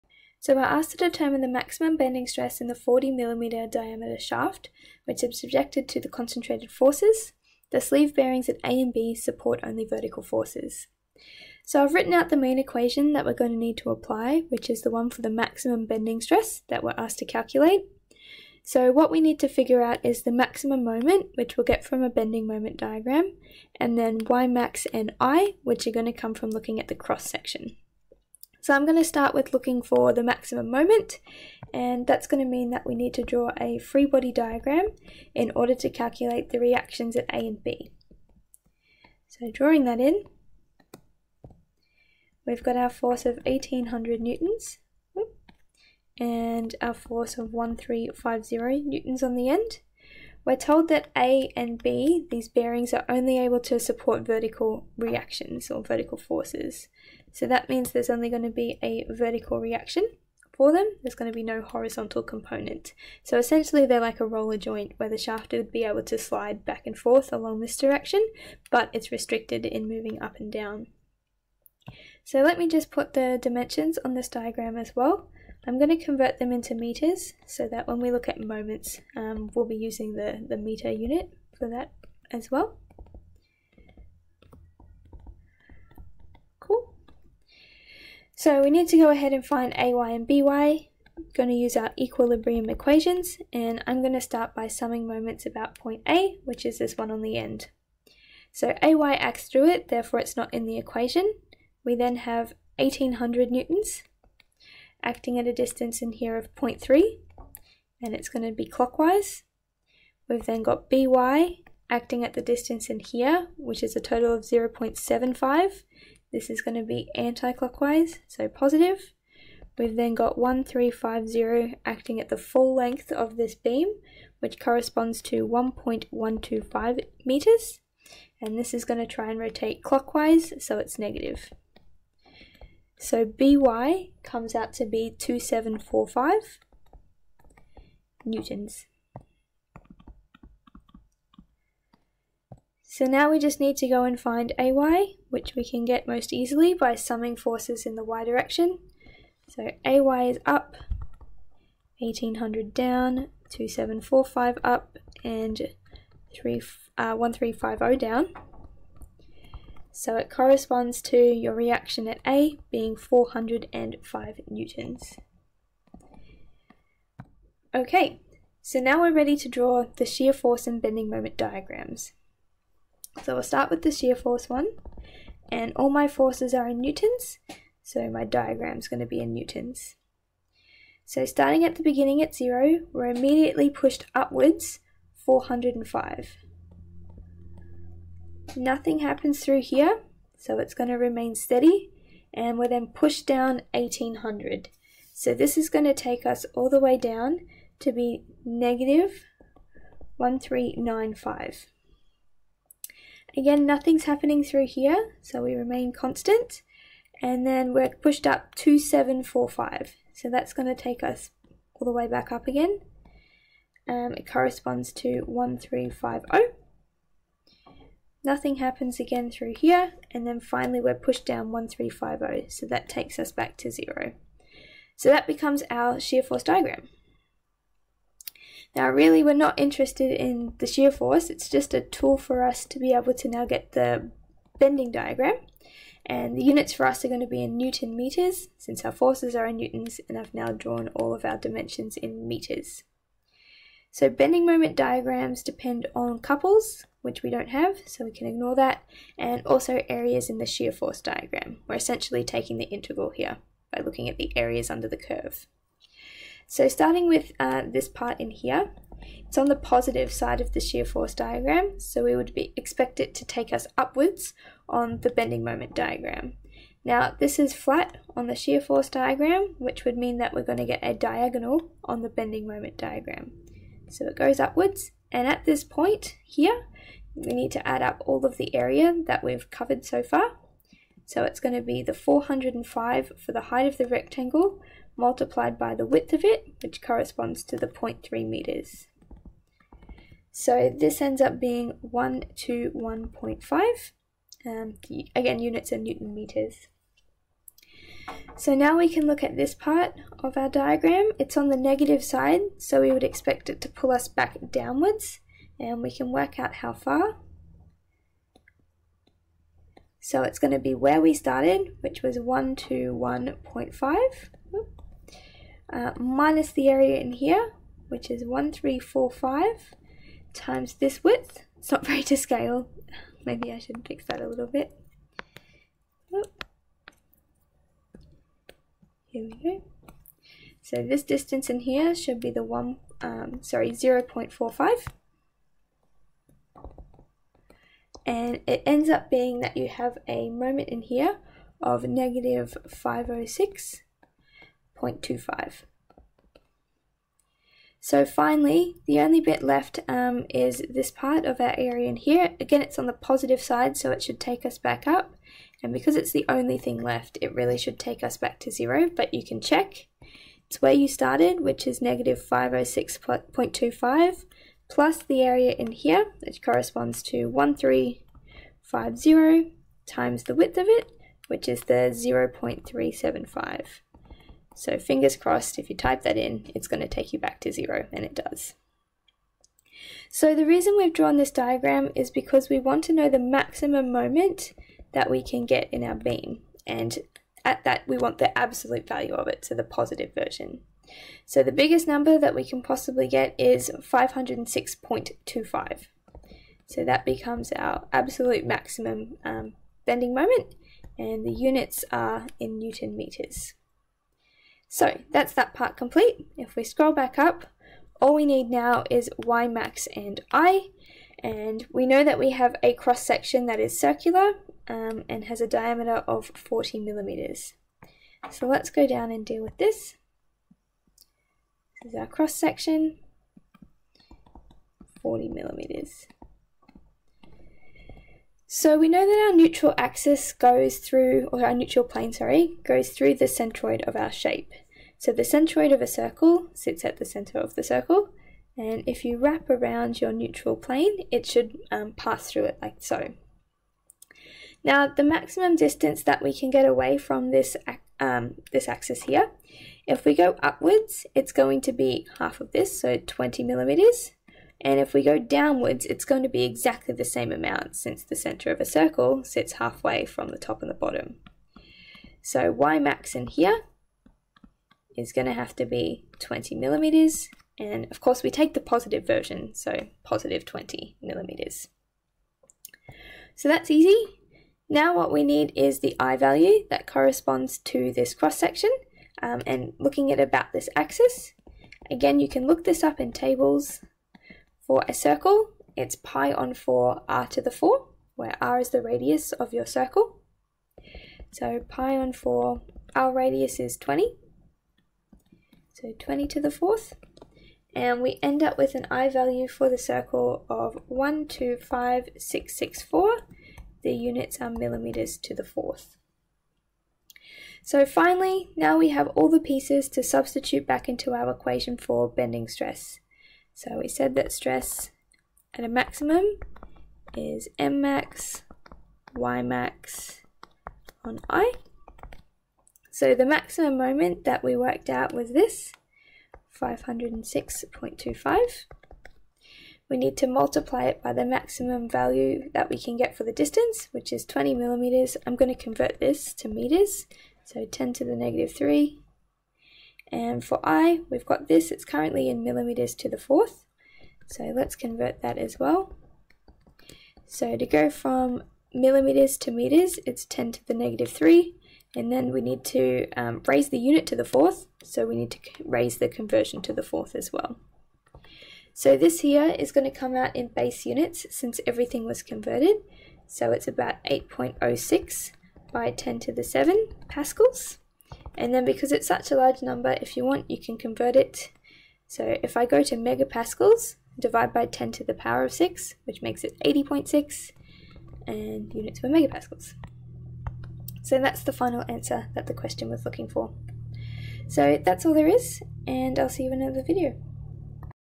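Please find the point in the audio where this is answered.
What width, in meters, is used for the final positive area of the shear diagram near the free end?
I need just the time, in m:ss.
6:11.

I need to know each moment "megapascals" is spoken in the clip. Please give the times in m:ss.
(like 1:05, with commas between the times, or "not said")
9:32, 9:39.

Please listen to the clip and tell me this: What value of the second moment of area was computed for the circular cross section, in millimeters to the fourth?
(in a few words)
125664.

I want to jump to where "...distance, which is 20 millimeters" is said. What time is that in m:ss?
8:53.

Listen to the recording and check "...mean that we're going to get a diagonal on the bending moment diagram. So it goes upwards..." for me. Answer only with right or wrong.
right.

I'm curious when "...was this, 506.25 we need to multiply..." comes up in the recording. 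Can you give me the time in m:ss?
8:45.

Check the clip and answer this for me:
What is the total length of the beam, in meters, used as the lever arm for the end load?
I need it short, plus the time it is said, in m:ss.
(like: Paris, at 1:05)
1.125 meters, at 2:05.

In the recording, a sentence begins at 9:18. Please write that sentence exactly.
So this here is going to come out in base units since everything was converted.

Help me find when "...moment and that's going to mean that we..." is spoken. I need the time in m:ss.
0:30.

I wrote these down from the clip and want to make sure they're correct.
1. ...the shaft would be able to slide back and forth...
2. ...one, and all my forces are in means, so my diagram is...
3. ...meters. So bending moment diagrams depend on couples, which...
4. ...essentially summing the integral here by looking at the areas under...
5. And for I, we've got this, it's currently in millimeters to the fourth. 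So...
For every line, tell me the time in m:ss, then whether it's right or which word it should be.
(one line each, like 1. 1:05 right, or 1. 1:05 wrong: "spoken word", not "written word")
1. 1:05 right
2. 2:54 wrong: "newtons", not "means"
3. 4:02 right
4. 4:11 wrong: "taking", not "summing"
5. 9:00 right.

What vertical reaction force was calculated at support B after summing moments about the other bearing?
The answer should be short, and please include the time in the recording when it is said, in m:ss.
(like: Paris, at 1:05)
2745 newtons, at 2:15.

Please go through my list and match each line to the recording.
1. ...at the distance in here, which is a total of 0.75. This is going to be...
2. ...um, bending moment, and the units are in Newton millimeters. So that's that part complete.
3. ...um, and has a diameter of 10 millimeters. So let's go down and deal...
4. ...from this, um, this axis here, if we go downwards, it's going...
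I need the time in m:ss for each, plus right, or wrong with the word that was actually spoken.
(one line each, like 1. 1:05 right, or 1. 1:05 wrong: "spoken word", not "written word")
1. 1:52 right
2. 6:39 wrong: "meters", not "millimeters"
3. 6:54 wrong: "40", not "10"
4. 7:26 wrong: "upwards", not "downwards".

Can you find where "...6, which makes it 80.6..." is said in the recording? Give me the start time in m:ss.
9:35.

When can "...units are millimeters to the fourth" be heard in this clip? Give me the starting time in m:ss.
8:23.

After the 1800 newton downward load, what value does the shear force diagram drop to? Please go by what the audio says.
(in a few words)
-1395.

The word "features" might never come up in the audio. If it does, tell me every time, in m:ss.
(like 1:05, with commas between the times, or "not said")
not said.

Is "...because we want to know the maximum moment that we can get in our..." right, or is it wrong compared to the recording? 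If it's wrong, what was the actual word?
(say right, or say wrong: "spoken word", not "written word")
right.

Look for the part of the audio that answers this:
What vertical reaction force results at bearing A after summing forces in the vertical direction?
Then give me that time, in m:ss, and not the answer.
2:42.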